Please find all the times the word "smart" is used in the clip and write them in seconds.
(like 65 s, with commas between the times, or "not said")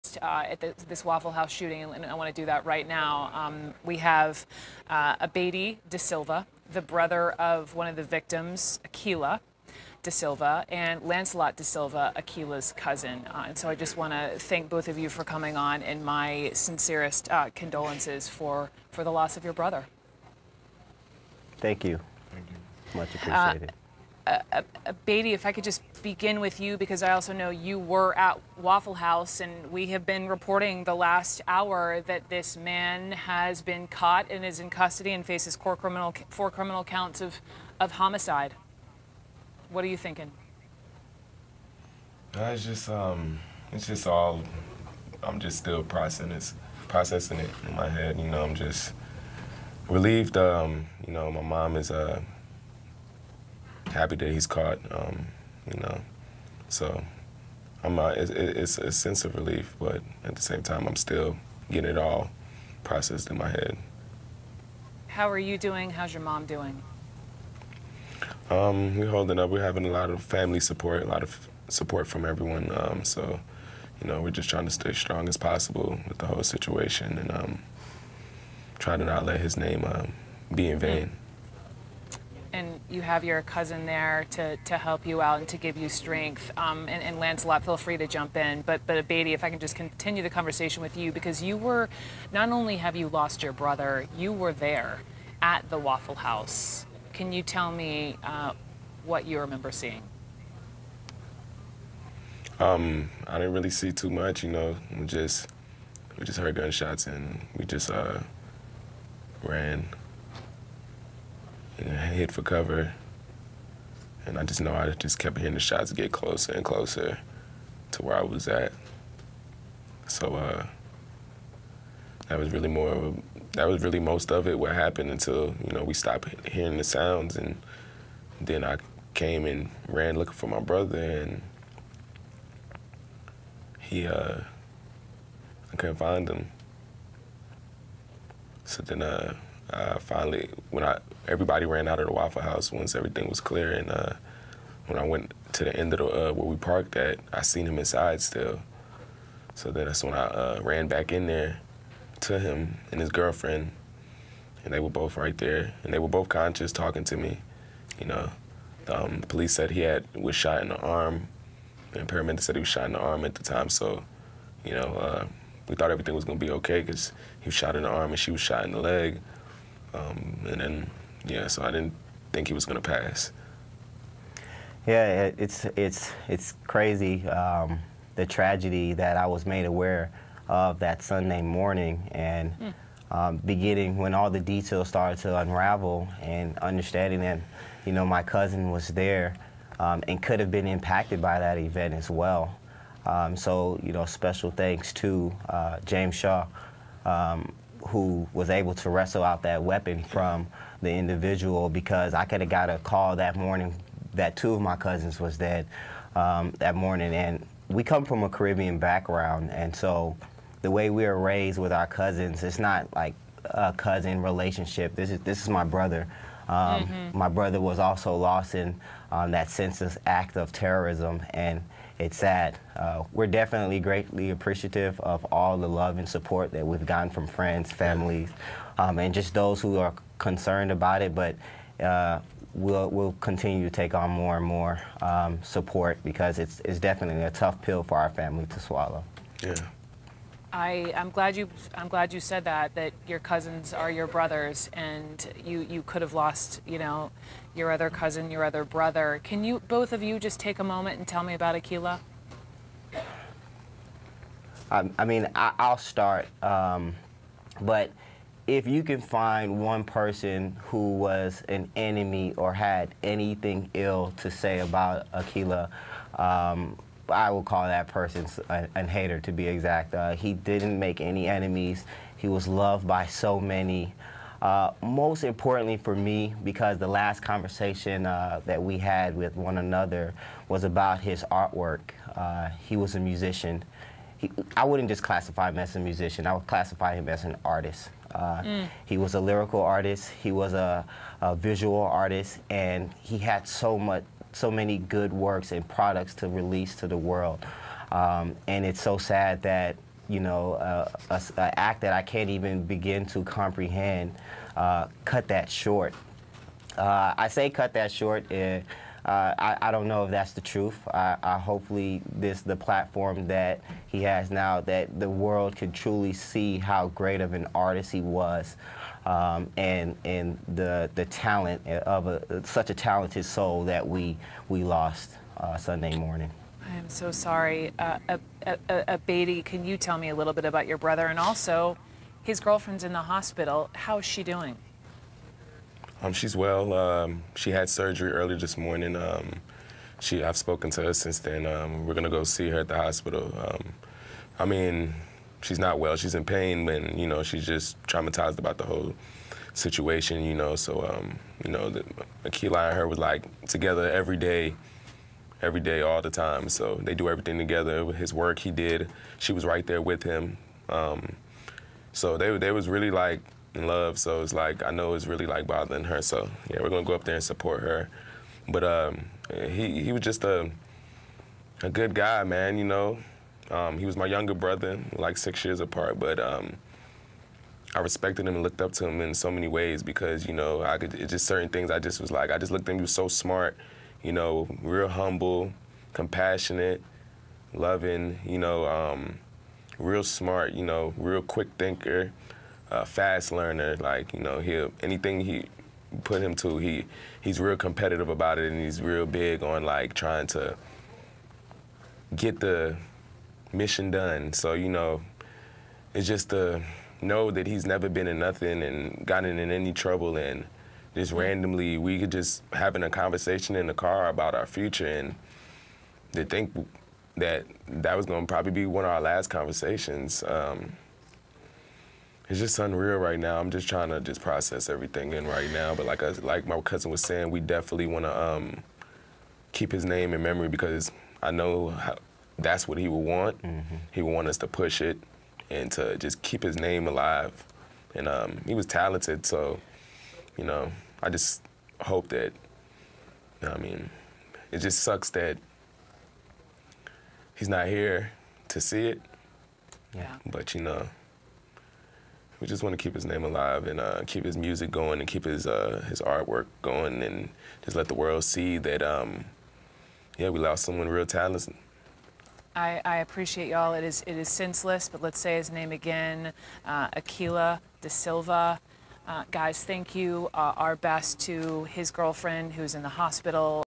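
383 s, 390 s.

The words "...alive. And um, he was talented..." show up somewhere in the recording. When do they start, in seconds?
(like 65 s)
436 s.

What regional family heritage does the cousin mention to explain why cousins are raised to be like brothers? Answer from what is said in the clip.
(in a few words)
Caribbean.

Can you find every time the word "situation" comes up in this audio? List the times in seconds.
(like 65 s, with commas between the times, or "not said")
76 s, 349 s.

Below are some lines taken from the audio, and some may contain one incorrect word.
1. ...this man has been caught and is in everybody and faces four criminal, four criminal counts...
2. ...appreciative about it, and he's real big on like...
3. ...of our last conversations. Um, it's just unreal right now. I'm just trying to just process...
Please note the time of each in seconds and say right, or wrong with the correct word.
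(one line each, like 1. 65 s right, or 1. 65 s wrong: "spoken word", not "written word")
1. 32 s wrong: "custody", not "everybody"
2. 397 s wrong: "competitive", not "appreciative"
3. 418 s right.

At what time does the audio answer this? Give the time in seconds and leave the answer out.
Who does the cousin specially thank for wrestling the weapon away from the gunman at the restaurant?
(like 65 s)
195 s.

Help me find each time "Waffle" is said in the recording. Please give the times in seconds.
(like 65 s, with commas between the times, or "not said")
1 s, 28 s, 95 s, 142 s.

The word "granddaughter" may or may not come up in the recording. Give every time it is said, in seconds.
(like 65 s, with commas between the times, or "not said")
not said.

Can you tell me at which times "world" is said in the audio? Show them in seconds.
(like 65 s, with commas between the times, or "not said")
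296 s, 315 s, 457 s.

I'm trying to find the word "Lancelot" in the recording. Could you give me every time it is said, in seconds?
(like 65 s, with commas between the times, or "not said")
11 s, 87 s.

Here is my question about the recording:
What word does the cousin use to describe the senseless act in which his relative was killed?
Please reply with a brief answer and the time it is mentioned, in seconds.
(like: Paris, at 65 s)
terrorism, at 220 s.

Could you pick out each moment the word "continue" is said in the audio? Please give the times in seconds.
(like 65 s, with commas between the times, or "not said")
89 s, 233 s.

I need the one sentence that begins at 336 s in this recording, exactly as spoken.
Um, she had surgery earlier this morning.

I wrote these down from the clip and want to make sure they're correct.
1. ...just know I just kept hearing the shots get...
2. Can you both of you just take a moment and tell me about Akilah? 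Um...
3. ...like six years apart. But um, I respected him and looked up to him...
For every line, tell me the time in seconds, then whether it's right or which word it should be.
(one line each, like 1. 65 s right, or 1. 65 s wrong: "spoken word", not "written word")
1. 114 s right
2. 249 s right
3. 374 s right.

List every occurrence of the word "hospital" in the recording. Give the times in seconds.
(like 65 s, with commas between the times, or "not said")
333 s, 342 s, 472 s.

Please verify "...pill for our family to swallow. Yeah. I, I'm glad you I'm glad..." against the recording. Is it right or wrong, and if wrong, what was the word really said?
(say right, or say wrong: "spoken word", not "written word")
right.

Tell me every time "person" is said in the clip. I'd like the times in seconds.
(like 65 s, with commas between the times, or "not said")
259 s, 267 s.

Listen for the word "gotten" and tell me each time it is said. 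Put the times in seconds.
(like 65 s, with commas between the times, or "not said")
226 s, 409 s.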